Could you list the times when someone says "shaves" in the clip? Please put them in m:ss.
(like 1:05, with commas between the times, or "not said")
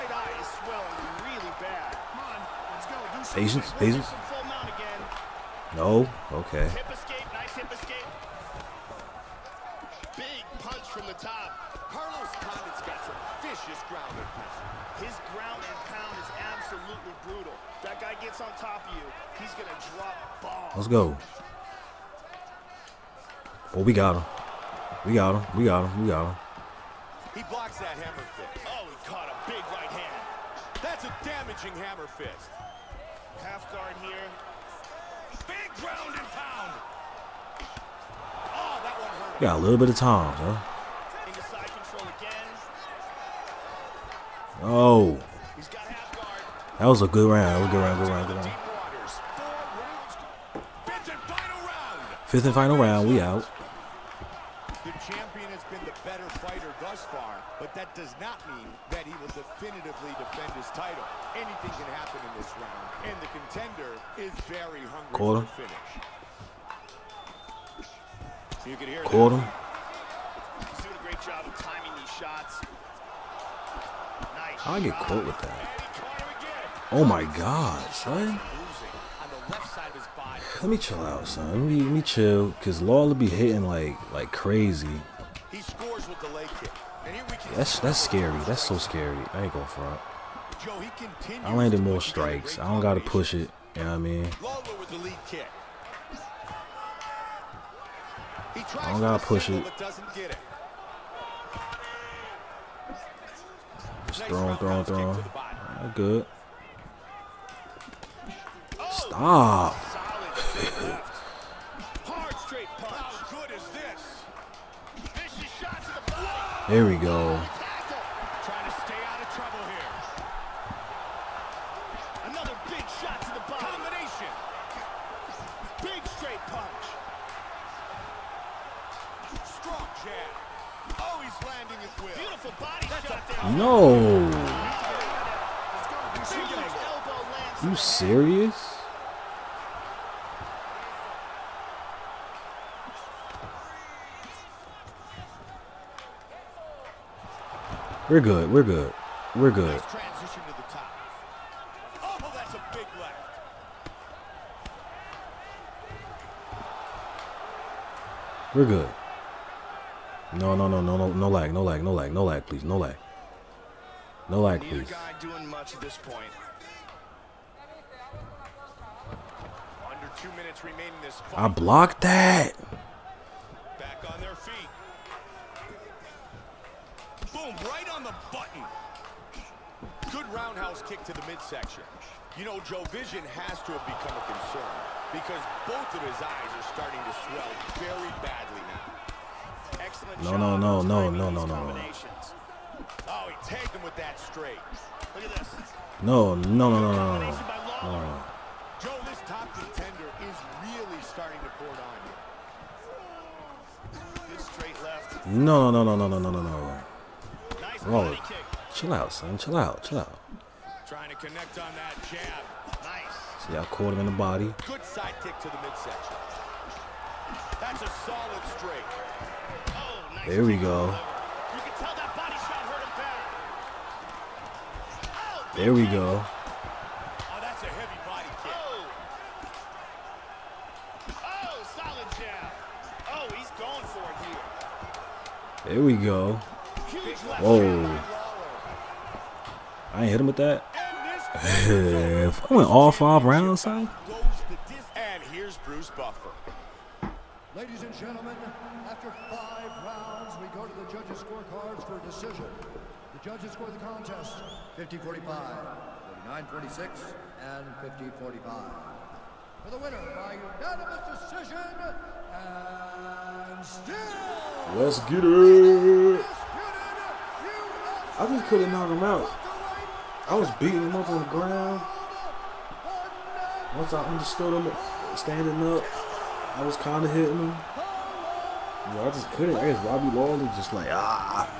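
not said.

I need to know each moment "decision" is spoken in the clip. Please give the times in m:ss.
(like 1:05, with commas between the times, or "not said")
4:12, 4:21.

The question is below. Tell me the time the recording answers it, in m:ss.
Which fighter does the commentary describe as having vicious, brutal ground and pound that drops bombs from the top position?
0:11.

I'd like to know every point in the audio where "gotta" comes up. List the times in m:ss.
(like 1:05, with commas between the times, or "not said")
1:32, 1:39.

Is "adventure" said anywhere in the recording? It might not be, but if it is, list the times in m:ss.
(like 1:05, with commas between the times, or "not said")
not said.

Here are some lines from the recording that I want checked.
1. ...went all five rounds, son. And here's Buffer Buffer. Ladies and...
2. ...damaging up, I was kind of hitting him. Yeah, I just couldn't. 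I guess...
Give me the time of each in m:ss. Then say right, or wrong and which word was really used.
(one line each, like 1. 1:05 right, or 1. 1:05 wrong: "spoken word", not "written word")
1. 4:02 wrong: "Bruce", not "Buffer"
2. 4:35 wrong: "standing", not "damaging".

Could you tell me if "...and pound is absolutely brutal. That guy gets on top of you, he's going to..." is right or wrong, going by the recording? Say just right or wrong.
right.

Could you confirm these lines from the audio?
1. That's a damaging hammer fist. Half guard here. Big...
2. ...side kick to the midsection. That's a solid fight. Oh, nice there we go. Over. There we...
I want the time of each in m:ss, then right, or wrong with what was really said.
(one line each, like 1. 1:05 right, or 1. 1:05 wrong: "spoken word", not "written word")
1. 0:30 right
2. 3:34 wrong: "straight", not "fight".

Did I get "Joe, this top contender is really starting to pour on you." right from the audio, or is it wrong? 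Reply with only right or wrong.
right.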